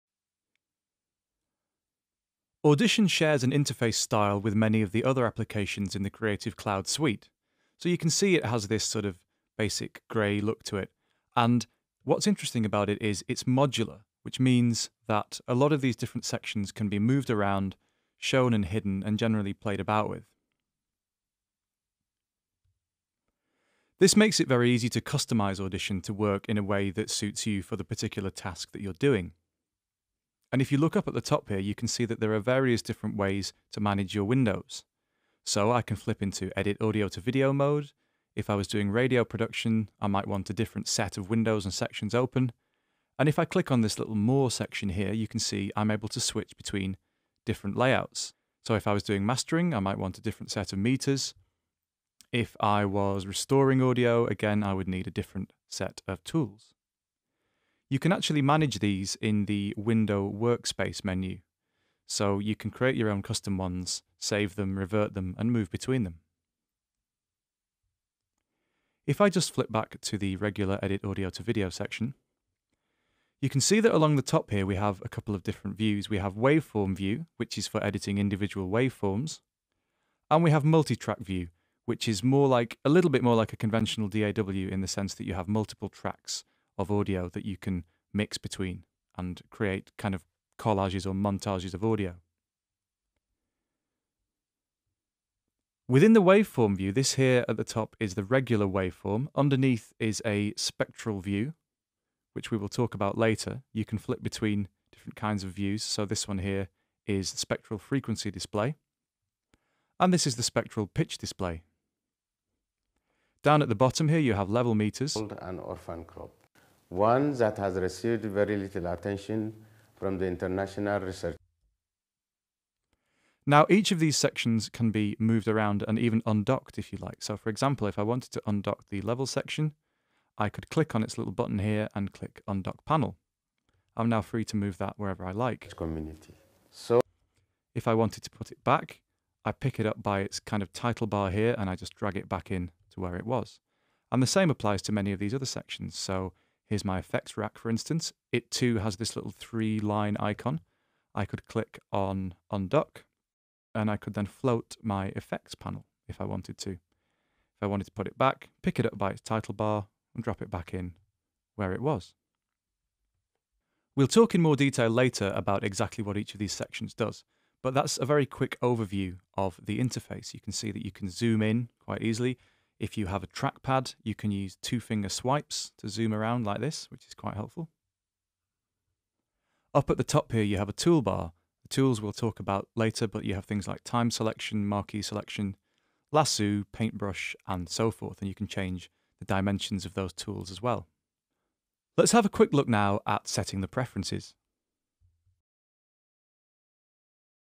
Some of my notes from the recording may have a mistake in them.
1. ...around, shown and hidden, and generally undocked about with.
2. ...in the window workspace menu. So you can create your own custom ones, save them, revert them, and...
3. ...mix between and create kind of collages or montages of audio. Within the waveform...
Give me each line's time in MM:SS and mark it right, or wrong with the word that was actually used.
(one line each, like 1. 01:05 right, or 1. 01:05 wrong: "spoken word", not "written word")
1. 00:17 wrong: "played", not "undocked"
2. 00:59 right
3. 01:28 right.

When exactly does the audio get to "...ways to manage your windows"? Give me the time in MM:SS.
00:33.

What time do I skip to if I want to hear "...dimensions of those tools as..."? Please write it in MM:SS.
03:09.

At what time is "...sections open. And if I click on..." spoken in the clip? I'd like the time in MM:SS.
00:41.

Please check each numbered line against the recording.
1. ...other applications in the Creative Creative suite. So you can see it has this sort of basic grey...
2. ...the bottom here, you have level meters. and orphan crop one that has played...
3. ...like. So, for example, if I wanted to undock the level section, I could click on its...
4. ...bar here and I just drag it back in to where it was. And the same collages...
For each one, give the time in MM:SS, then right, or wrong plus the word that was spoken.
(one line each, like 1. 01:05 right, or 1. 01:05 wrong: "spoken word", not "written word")
1. 00:05 wrong: "Cloud", not "Creative"
2. 01:53 wrong: "received", not "played"
3. 02:07 right
4. 02:21 wrong: "applies", not "collages".